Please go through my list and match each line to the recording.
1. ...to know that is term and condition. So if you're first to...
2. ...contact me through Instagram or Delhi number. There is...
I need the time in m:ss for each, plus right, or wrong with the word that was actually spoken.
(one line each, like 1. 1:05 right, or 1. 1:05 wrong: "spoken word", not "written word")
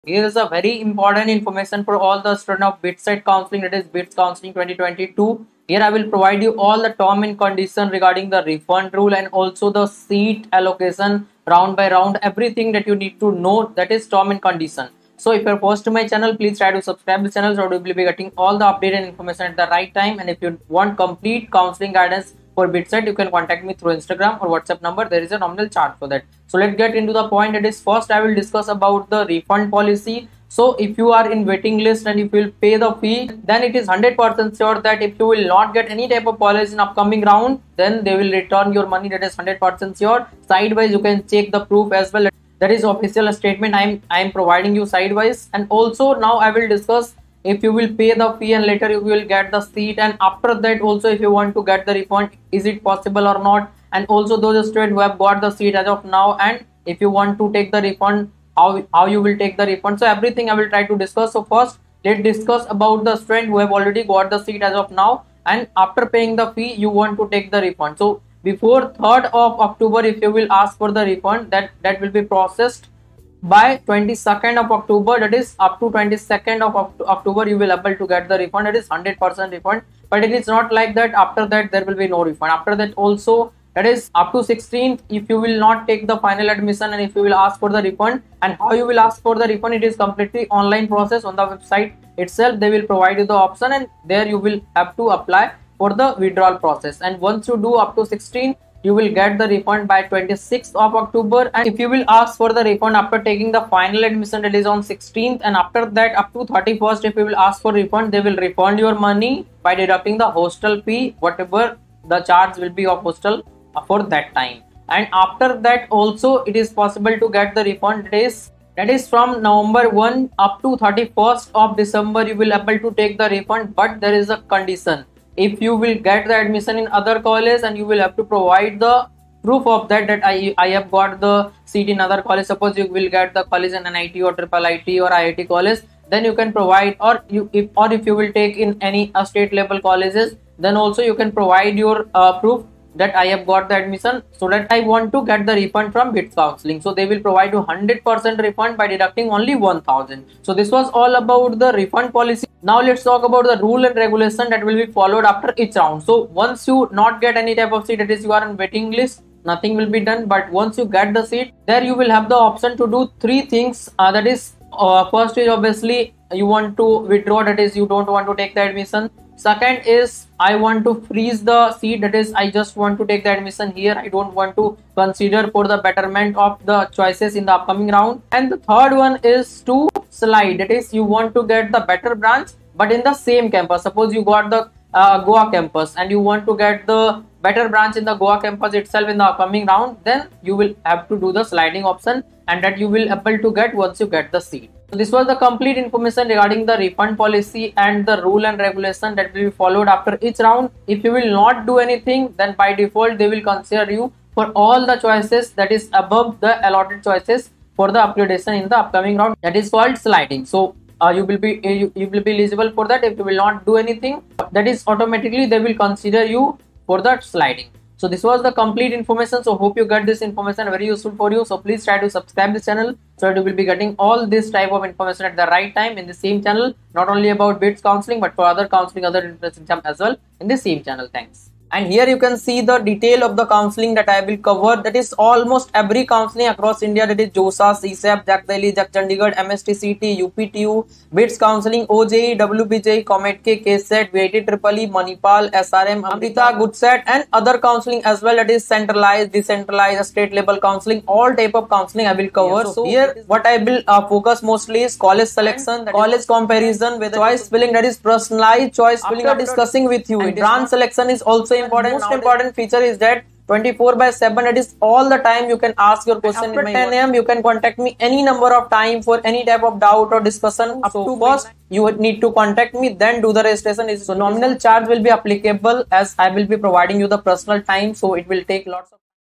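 1. 0:13 right
2. 0:23 wrong: "WhatsApp", not "Delhi".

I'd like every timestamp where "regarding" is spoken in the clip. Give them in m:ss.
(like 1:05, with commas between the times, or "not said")
0:07, 3:16.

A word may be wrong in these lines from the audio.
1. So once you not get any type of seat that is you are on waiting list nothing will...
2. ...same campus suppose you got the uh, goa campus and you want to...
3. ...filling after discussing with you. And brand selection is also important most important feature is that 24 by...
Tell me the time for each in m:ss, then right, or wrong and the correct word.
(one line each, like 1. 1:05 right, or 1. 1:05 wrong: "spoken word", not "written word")
1. 2:36 right
2. 3:03 right
3. 4:19 right.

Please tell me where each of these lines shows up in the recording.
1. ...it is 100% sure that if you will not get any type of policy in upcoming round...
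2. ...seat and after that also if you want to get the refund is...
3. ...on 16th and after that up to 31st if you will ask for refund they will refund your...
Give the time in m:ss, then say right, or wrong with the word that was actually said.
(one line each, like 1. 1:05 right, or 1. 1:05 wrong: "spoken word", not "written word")
1. 0:33 right
2. 0:49 right
3. 1:44 right.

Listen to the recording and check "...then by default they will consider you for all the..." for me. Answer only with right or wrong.
right.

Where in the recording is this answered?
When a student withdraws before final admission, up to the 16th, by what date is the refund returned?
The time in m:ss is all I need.
1:40.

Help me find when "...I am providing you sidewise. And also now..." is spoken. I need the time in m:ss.
0:44.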